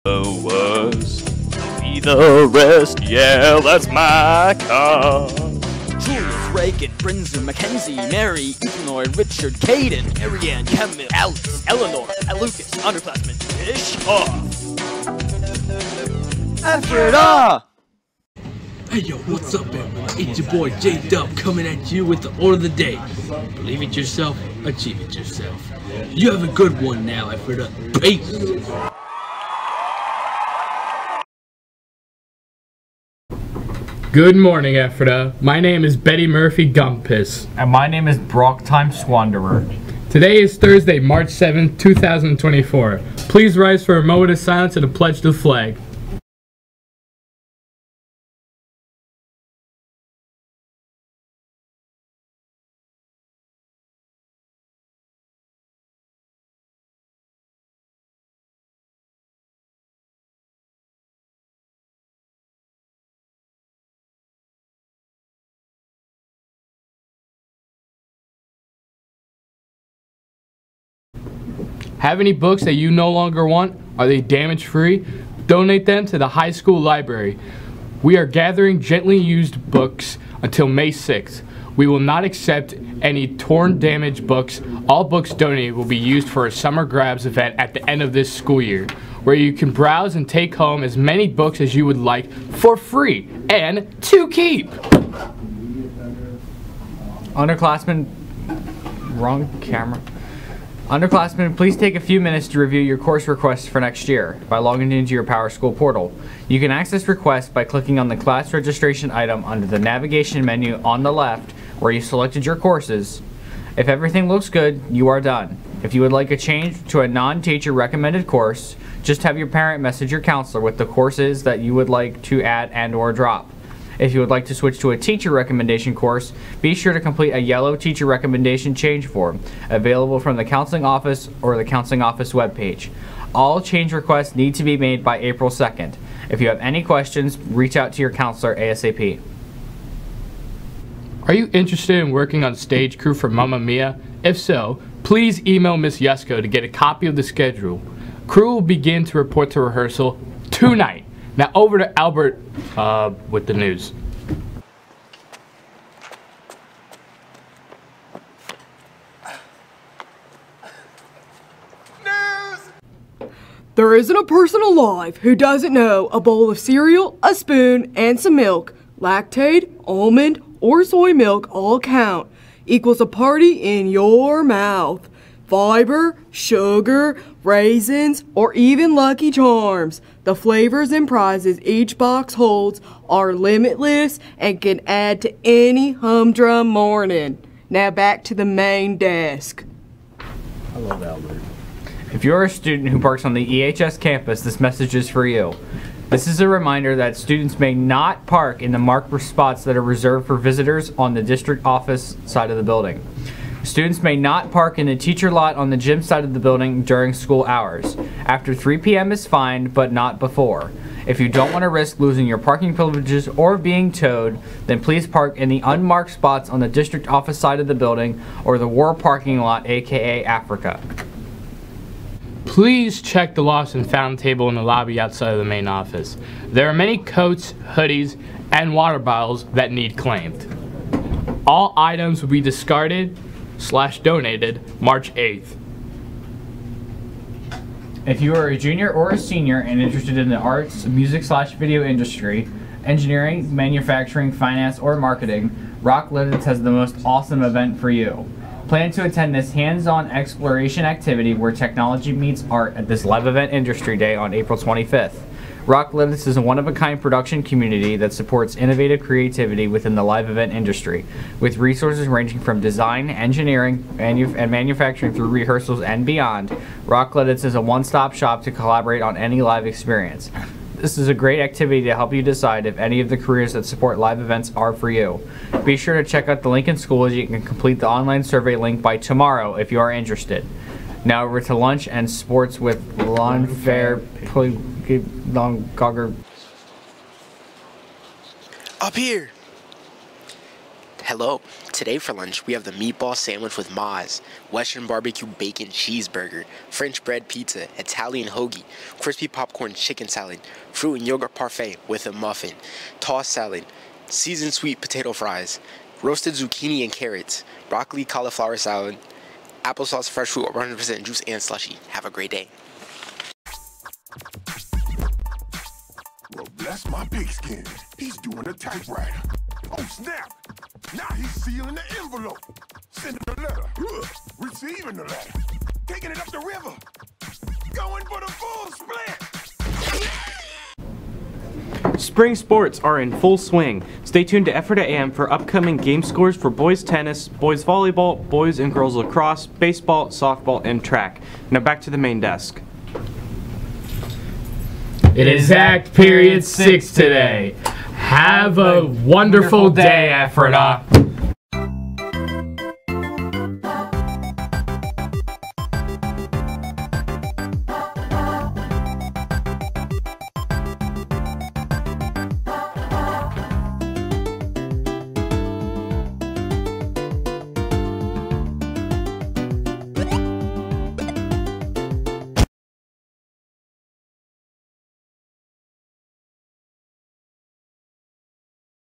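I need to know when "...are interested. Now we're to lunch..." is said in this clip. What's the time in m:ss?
4:39.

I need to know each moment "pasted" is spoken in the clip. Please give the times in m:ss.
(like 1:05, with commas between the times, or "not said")
not said.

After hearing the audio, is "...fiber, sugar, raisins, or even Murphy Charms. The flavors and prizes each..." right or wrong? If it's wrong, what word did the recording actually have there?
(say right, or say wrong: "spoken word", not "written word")
wrong: "Lucky", not "Murphy".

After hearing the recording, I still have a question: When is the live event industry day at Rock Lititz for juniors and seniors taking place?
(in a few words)
April 25th.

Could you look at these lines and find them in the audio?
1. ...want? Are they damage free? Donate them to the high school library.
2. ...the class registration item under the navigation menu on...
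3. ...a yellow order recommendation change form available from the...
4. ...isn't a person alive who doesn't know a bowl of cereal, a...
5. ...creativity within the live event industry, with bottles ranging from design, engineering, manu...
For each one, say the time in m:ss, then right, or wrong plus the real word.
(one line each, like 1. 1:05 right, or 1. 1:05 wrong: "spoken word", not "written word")
1. 1:13 right
2. 1:48 right
3. 2:07 wrong: "teacher", not "order"
4. 2:43 right
5. 4:19 wrong: "resources", not "bottles".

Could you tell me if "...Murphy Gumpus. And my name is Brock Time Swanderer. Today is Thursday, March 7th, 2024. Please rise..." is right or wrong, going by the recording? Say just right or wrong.
right.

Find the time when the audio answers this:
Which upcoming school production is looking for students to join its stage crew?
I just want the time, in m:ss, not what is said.
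2:23.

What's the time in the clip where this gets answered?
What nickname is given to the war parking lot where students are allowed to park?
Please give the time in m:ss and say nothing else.
3:40.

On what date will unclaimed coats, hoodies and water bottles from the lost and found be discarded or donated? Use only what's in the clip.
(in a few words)
March 8th.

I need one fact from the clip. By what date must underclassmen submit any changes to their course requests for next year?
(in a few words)
April 2nd.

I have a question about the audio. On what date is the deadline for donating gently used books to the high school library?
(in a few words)
May 6th.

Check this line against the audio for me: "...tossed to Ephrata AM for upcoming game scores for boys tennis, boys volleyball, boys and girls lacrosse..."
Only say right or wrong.
wrong.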